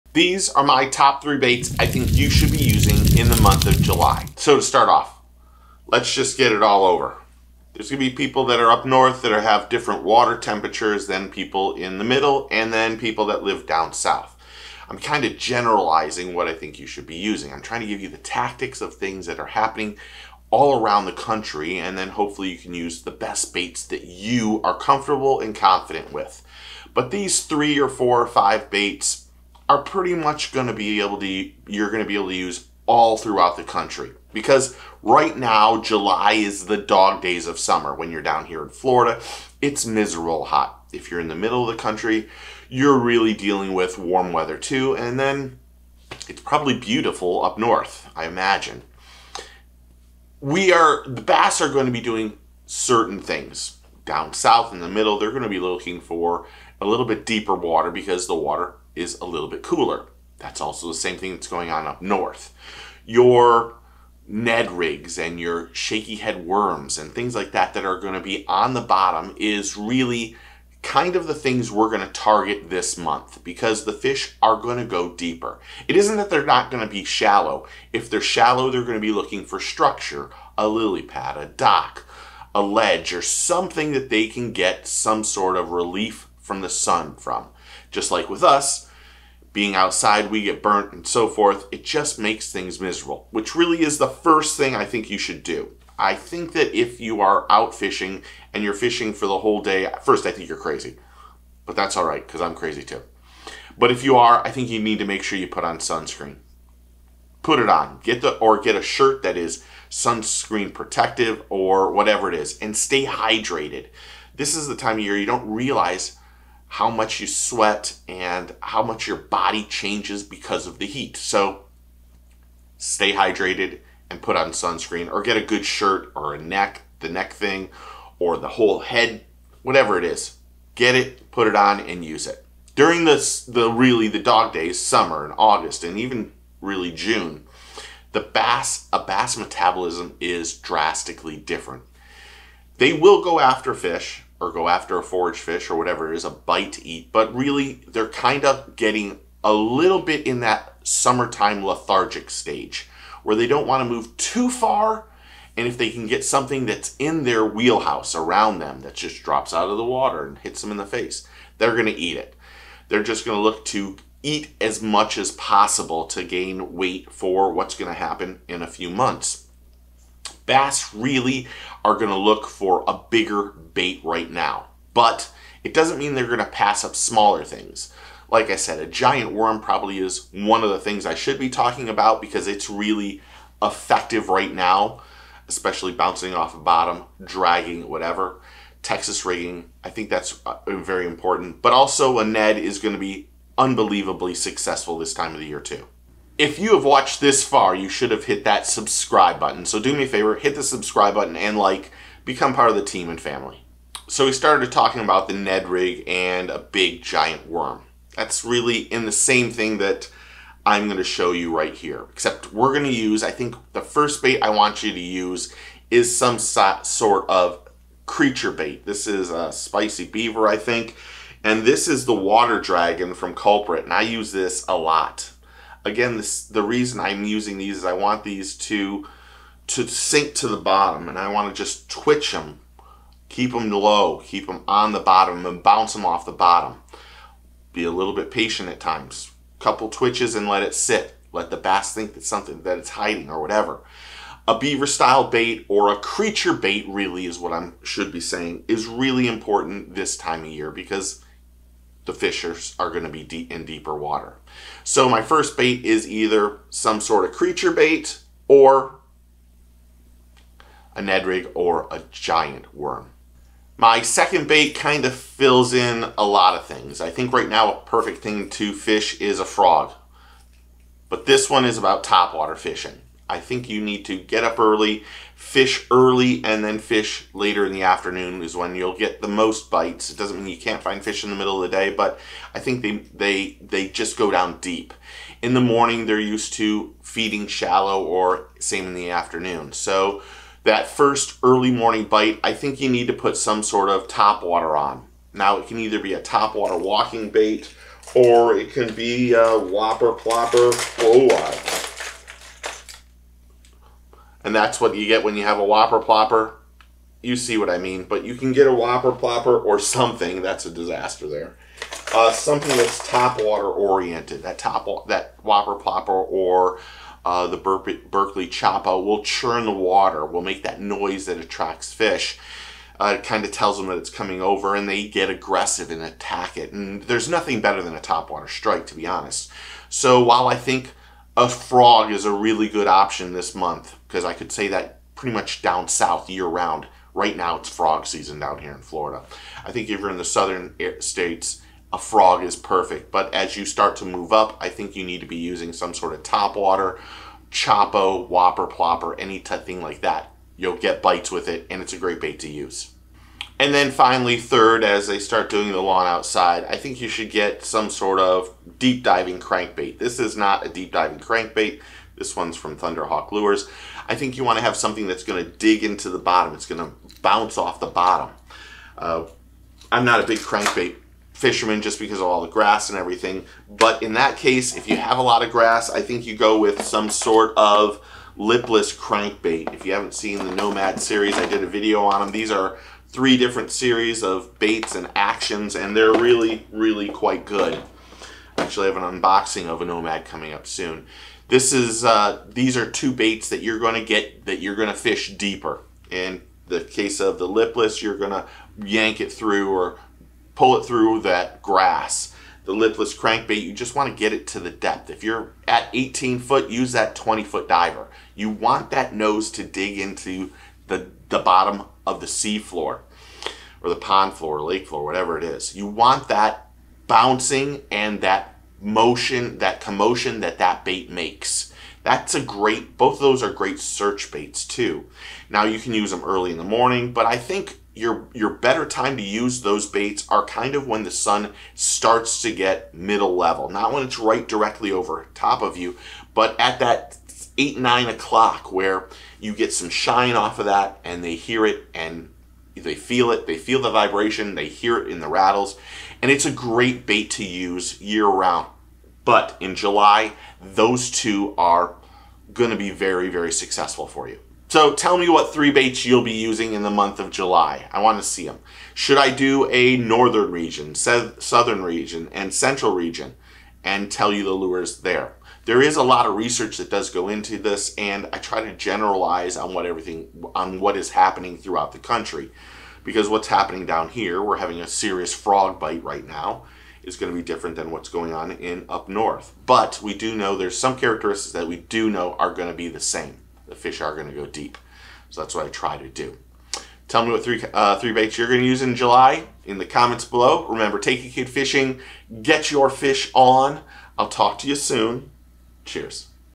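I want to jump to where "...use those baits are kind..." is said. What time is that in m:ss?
7:09.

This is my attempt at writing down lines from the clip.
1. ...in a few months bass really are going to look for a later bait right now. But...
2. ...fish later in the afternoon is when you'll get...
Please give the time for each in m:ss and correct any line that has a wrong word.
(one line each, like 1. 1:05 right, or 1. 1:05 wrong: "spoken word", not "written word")
1. 2:48 wrong: "bigger", not "later"
2. 4:36 right.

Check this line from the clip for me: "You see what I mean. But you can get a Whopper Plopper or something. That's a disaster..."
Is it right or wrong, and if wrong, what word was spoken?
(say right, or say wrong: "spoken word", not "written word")
right.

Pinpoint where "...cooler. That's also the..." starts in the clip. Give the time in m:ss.
0:59.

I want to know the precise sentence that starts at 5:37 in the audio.
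Right now, it's frog season down here in Florida.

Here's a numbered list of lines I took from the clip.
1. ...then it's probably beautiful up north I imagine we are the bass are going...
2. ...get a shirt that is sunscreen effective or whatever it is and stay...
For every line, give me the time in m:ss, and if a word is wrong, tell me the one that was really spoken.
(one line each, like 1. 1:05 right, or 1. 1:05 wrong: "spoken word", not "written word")
1. 0:45 right
2. 1:48 wrong: "protective", not "effective".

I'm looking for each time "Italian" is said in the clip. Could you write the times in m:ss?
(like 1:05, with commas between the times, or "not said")
not said.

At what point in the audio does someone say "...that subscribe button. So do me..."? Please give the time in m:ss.
3:18.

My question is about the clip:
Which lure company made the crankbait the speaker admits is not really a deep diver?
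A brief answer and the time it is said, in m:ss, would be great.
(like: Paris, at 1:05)
Thunderhawk Lures, at 6:02.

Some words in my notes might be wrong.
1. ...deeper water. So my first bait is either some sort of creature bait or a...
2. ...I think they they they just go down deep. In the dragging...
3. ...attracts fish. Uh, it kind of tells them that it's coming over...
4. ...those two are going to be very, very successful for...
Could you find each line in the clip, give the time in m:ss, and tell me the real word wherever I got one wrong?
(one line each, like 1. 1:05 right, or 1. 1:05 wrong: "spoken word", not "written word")
1. 4:13 right
2. 4:42 wrong: "morning", not "dragging"
3. 5:21 right
4. 7:30 right.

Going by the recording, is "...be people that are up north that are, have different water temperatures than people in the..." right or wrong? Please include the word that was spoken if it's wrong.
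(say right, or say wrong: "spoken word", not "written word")
right.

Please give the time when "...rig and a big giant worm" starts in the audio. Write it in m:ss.
3:25.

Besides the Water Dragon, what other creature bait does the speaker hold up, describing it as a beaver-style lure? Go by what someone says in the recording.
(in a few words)
spicy beaver.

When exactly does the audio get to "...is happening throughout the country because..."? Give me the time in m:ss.
7:50.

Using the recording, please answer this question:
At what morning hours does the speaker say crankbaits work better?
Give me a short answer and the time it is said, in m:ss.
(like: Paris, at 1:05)
8 or 9 o'clock, at 7:17.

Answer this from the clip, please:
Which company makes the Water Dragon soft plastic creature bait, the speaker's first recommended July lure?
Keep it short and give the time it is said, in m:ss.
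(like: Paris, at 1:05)
Culprit, at 3:43.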